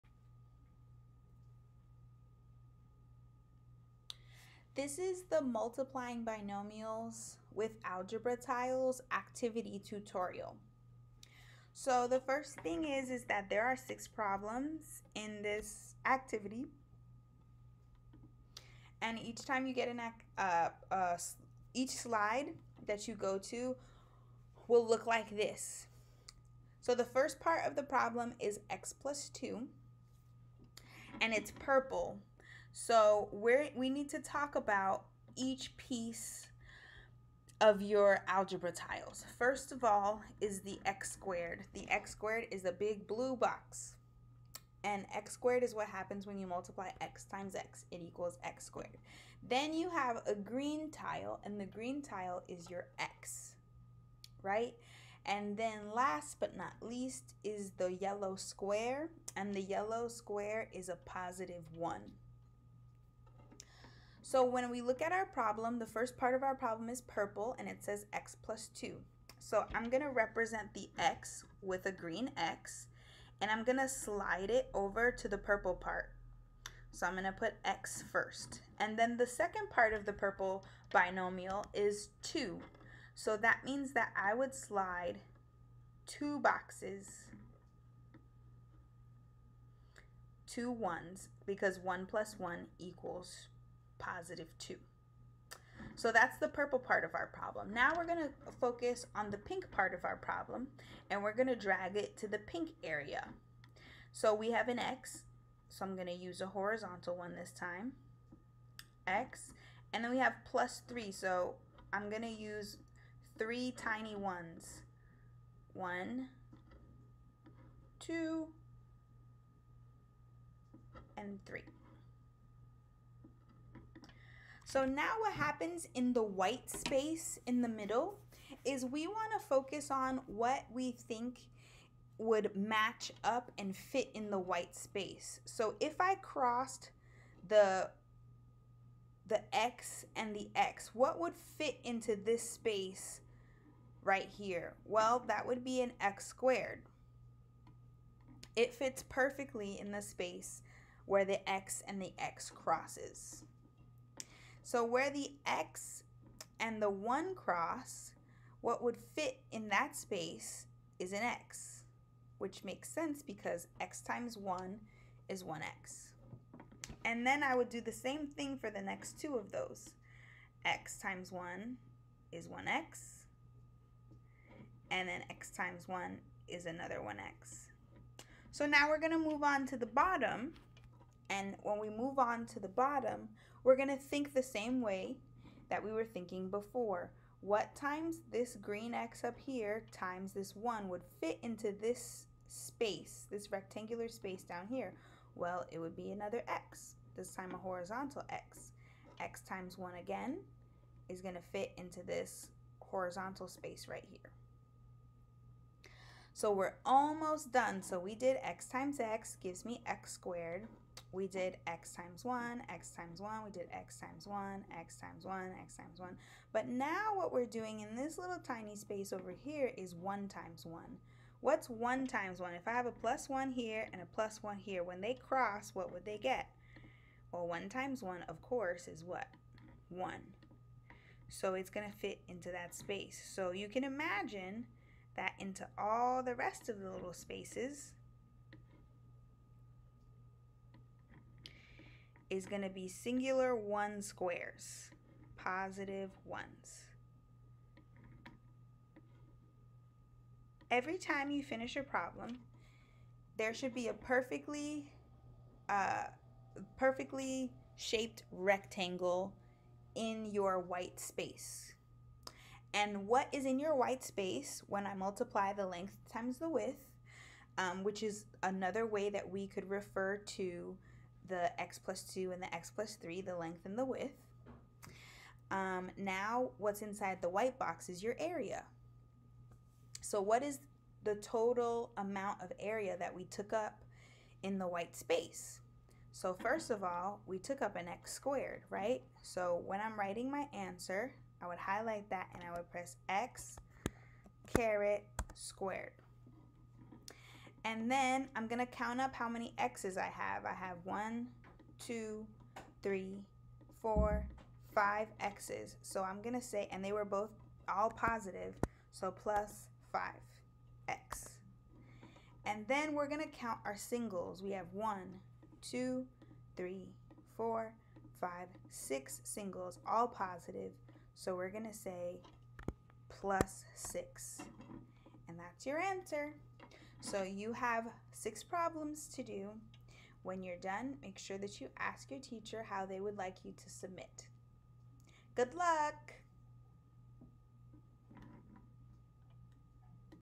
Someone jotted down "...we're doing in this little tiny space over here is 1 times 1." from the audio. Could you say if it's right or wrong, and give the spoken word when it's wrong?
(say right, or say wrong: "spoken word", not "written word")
right.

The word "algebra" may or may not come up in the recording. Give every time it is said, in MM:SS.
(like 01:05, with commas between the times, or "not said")
00:07, 00:38.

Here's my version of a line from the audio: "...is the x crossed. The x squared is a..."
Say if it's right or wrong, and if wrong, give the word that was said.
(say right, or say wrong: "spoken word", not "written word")
wrong: "squared", not "crossed".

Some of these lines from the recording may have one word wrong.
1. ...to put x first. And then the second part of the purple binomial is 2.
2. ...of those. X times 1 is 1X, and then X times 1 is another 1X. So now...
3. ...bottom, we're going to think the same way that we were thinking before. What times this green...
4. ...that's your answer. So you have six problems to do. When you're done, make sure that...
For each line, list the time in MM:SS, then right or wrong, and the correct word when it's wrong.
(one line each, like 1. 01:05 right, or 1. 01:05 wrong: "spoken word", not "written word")
1. 01:17 right
2. 02:49 right
3. 03:02 right
4. 05:25 right.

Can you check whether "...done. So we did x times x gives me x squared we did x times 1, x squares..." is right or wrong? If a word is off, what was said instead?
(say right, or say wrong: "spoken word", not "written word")
wrong: "times", not "squares".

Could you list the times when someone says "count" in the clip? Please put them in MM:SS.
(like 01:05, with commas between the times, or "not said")
04:58, 05:13.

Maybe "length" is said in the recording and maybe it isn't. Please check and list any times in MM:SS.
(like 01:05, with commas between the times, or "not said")
04:25, 04:33.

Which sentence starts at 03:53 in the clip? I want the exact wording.
So you can imagine that into all the rest of the little spaces, is going to be singular 1 squares, 1s.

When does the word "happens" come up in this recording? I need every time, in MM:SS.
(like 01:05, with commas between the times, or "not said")
00:45, 02:05.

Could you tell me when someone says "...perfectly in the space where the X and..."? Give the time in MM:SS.
02:29.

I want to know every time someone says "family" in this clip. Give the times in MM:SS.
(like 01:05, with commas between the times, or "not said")
not said.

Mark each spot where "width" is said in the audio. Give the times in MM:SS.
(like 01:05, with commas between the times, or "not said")
04:26, 04:33.